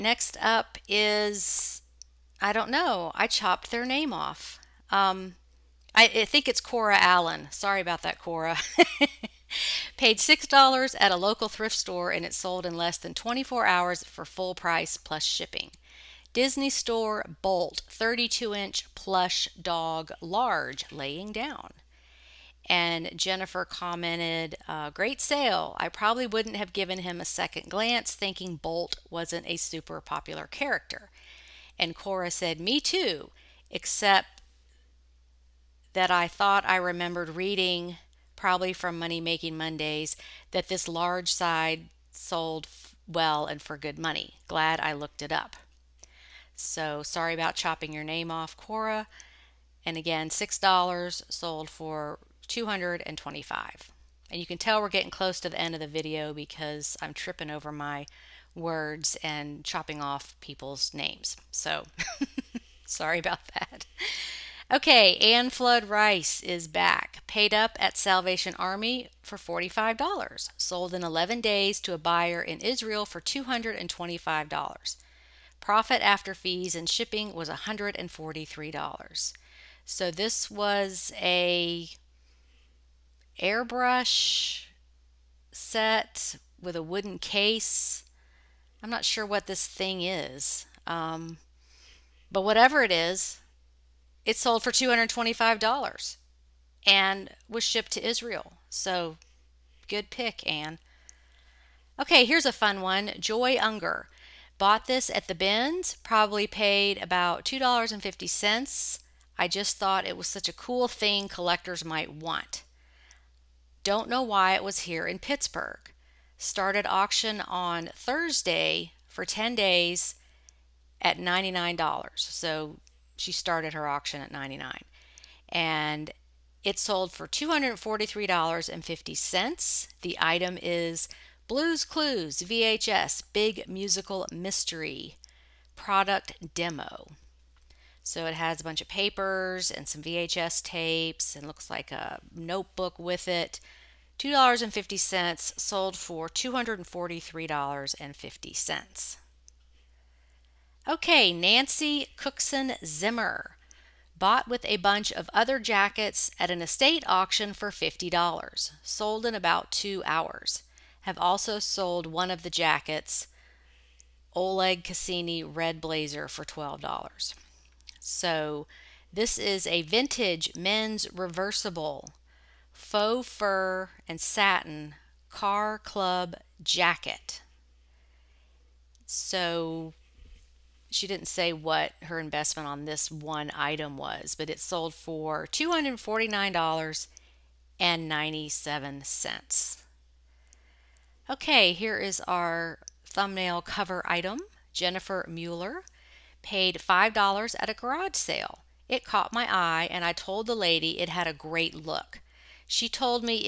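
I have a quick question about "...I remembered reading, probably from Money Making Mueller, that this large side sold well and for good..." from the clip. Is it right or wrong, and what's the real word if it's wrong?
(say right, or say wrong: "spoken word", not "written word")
wrong: "Mondays", not "Mueller".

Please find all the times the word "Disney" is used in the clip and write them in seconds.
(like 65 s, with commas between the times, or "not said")
16 s.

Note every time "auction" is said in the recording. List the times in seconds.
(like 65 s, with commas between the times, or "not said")
116 s, 123 s, 157 s.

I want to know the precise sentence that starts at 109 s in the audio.
I just thought it was such a cool thing collectors might want.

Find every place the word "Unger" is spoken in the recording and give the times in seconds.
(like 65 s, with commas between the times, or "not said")
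103 s.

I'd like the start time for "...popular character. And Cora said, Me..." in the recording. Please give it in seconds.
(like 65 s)
30 s.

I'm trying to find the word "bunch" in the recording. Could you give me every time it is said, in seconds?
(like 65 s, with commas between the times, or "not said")
138 s, 154 s.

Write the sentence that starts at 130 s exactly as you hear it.
The item is Blues Clues VHS Big Musical Mystery Product Demo.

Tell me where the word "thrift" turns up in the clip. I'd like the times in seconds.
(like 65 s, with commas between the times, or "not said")
11 s.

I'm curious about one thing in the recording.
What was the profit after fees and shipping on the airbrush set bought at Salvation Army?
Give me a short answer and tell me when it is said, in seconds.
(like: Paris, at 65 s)
$143, at 77 s.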